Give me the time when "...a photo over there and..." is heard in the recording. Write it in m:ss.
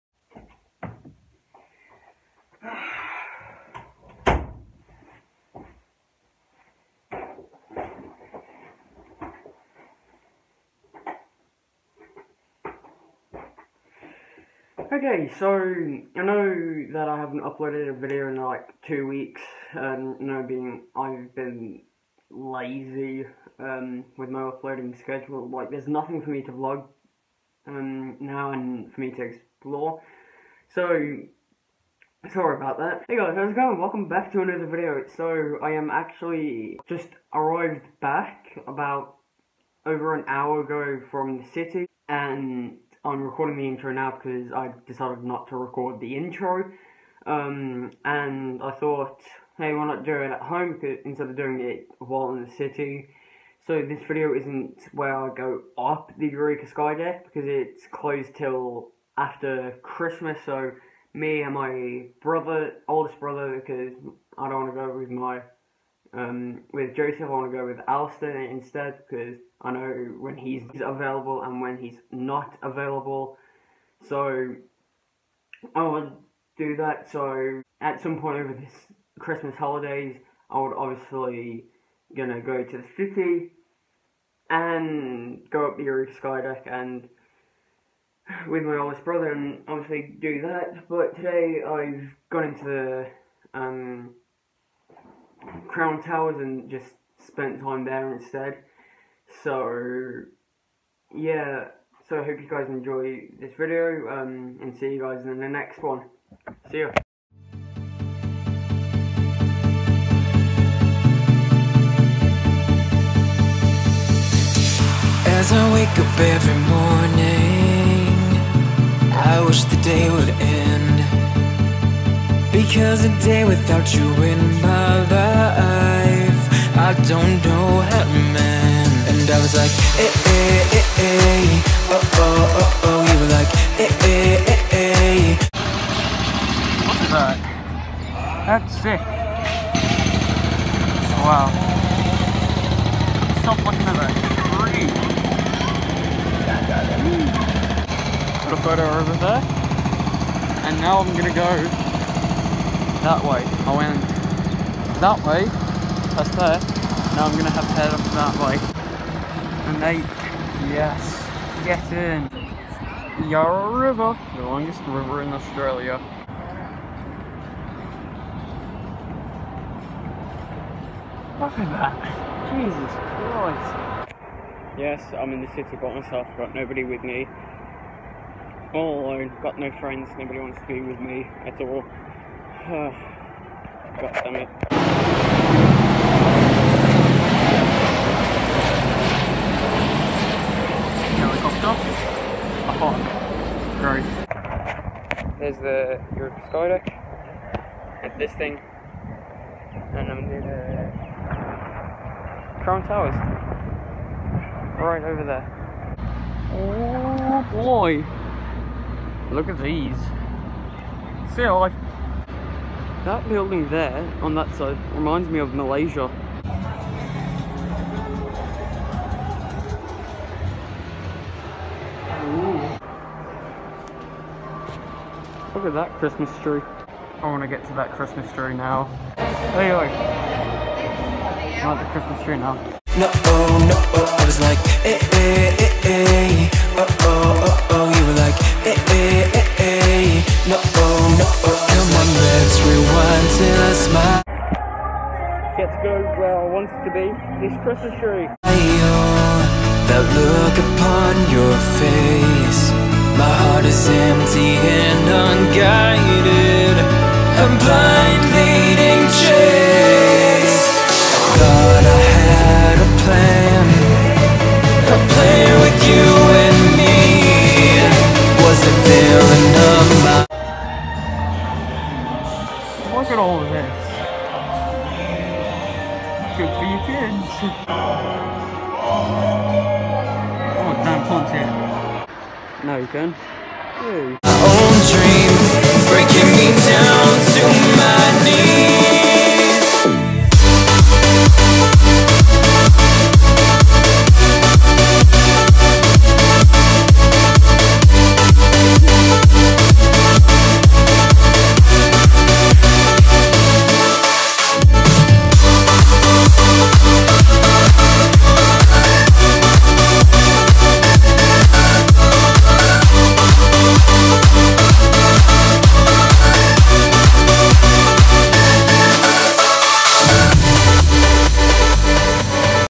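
2:28.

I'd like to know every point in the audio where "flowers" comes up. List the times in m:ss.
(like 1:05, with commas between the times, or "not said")
not said.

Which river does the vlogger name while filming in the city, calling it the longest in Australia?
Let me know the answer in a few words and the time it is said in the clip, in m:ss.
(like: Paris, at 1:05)
Yarra River, at 2:43.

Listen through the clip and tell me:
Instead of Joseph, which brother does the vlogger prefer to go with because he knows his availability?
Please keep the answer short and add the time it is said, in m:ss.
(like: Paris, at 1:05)
Alistair, at 1:07.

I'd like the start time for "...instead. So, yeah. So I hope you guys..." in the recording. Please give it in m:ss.
1:38.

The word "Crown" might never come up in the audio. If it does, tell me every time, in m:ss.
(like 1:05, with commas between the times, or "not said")
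1:35, 3:22.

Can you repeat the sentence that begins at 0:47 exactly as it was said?
Um, and I thought, hey, why not do it at home instead of doing it while in the city?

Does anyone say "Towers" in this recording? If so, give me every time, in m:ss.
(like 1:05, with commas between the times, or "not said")
1:36, 3:22.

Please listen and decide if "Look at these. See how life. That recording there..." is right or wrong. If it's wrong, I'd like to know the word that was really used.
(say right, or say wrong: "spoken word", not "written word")
wrong: "building", not "recording".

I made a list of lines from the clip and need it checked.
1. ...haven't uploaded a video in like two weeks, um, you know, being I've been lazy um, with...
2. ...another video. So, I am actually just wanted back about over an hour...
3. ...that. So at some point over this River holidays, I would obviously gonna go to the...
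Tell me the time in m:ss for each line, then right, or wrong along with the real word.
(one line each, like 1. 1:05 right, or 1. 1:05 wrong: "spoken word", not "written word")
1. 0:17 right
2. 0:34 wrong: "arrived", not "wanted"
3. 1:16 wrong: "Christmas", not "River".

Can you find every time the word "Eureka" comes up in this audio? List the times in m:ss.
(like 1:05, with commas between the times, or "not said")
0:56, 1:25.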